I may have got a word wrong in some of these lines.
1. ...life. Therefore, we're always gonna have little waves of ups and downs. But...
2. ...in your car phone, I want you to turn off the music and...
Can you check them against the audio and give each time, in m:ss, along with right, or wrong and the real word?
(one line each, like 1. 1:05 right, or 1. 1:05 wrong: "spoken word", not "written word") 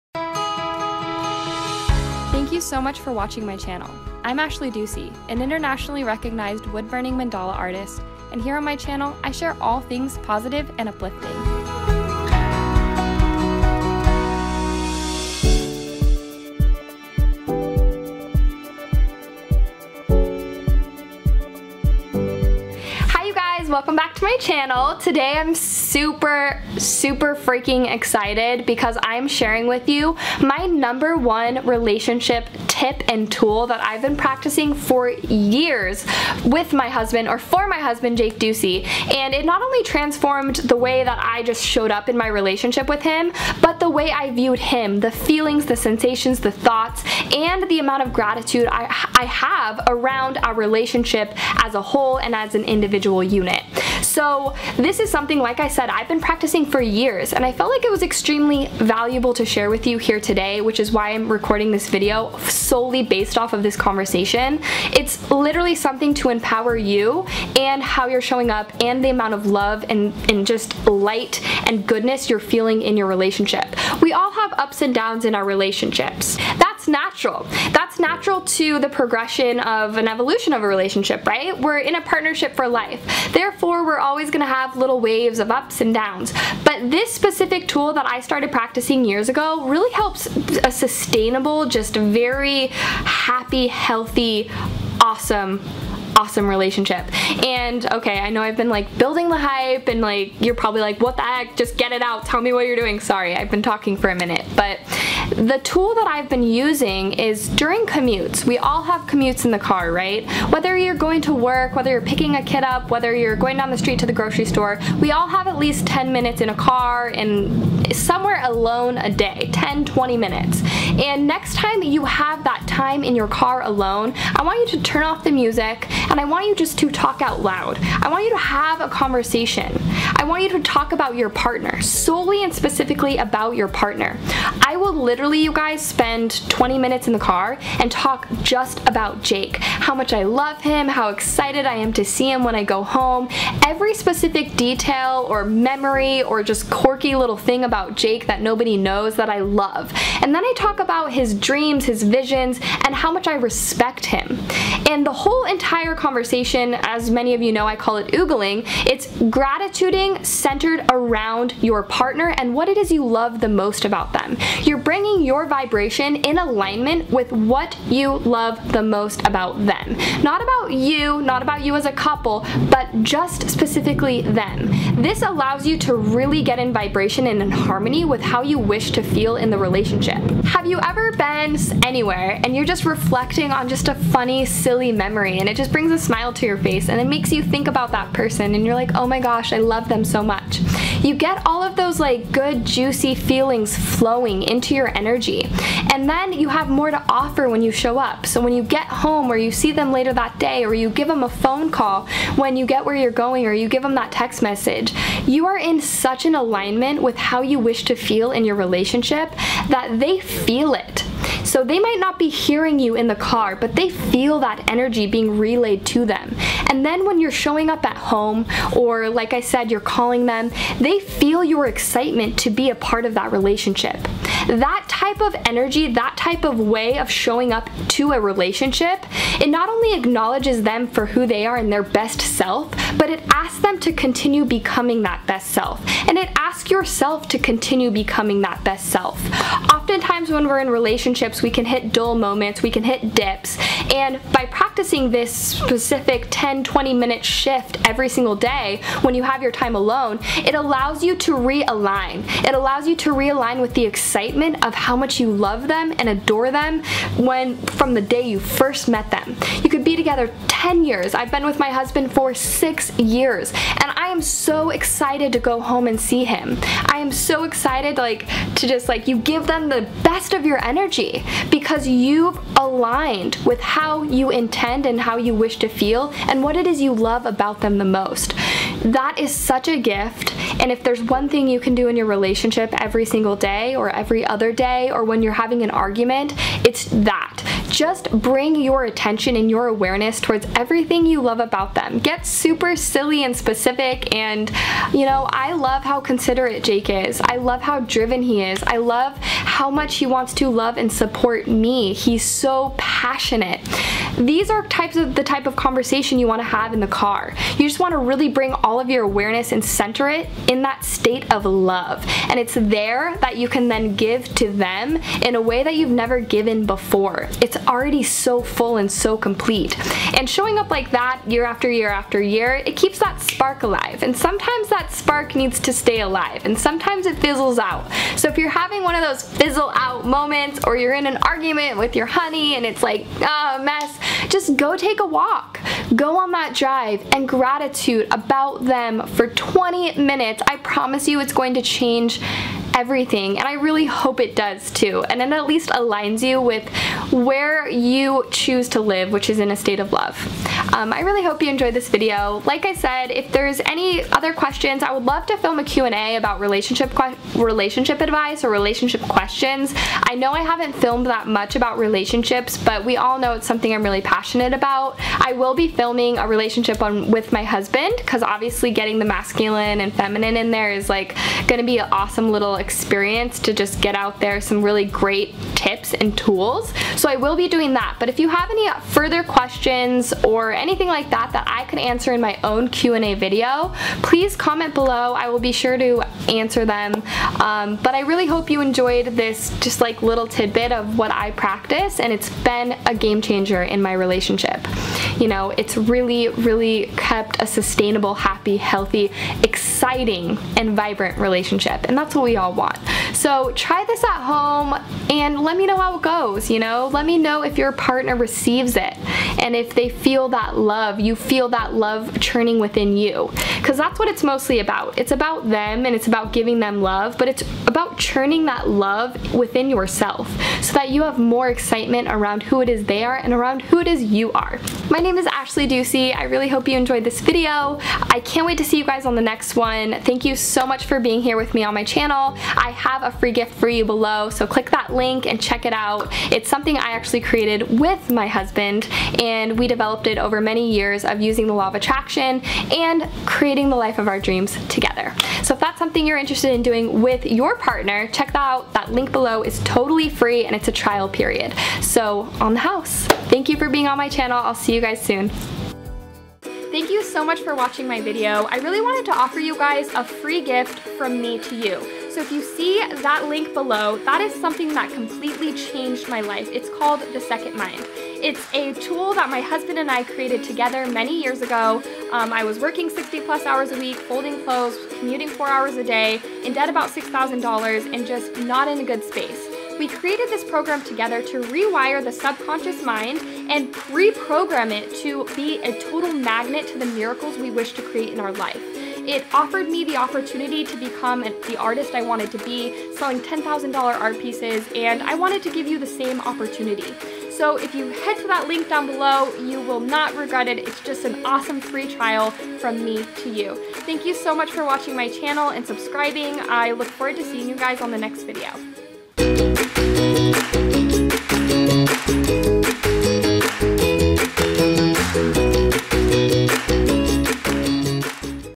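1. 1:22 right
2. 2:03 wrong: "alone", not "phone".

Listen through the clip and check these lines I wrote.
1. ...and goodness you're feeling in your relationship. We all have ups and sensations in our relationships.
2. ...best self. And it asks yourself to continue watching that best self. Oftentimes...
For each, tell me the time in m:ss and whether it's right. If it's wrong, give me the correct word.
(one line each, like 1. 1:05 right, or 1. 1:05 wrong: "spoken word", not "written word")
1. 1:11 wrong: "downs", not "sensations"
2. 3:55 wrong: "becoming", not "watching".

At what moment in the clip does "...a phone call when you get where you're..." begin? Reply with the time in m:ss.
3:21.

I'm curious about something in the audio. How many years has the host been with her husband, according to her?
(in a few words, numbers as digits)
6.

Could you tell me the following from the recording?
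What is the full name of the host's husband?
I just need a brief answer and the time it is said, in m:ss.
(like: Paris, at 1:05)
Jake Ducey, at 0:38.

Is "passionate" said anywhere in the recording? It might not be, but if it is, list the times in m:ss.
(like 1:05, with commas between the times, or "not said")
5:02, 6:04.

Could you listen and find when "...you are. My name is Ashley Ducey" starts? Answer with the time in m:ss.
7:04.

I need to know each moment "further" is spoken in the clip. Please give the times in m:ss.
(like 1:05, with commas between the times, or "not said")
6:18.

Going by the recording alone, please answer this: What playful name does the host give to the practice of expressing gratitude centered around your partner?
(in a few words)
Oogling.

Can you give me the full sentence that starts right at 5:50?
Um, I really hope you enjoyed this video.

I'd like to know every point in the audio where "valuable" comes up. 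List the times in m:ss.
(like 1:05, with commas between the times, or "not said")
0:58.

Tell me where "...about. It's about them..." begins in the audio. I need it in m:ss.
6:54.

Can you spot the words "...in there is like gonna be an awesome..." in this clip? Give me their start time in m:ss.
6:10.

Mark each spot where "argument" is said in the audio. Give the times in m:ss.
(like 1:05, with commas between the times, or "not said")
4:45, 5:31.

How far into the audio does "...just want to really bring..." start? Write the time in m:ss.
5:07.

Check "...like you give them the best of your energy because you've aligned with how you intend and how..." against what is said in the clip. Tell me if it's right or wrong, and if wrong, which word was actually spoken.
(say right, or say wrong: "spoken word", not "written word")
right.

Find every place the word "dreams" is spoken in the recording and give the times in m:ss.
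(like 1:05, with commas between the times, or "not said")
2:31, 7:24.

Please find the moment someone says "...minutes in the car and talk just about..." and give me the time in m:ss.
2:16.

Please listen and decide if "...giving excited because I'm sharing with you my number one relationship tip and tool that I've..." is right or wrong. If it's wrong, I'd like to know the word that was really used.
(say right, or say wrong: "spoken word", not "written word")
wrong: "freaking", not "giving".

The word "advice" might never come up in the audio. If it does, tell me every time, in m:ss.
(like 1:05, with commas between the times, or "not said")
5:58.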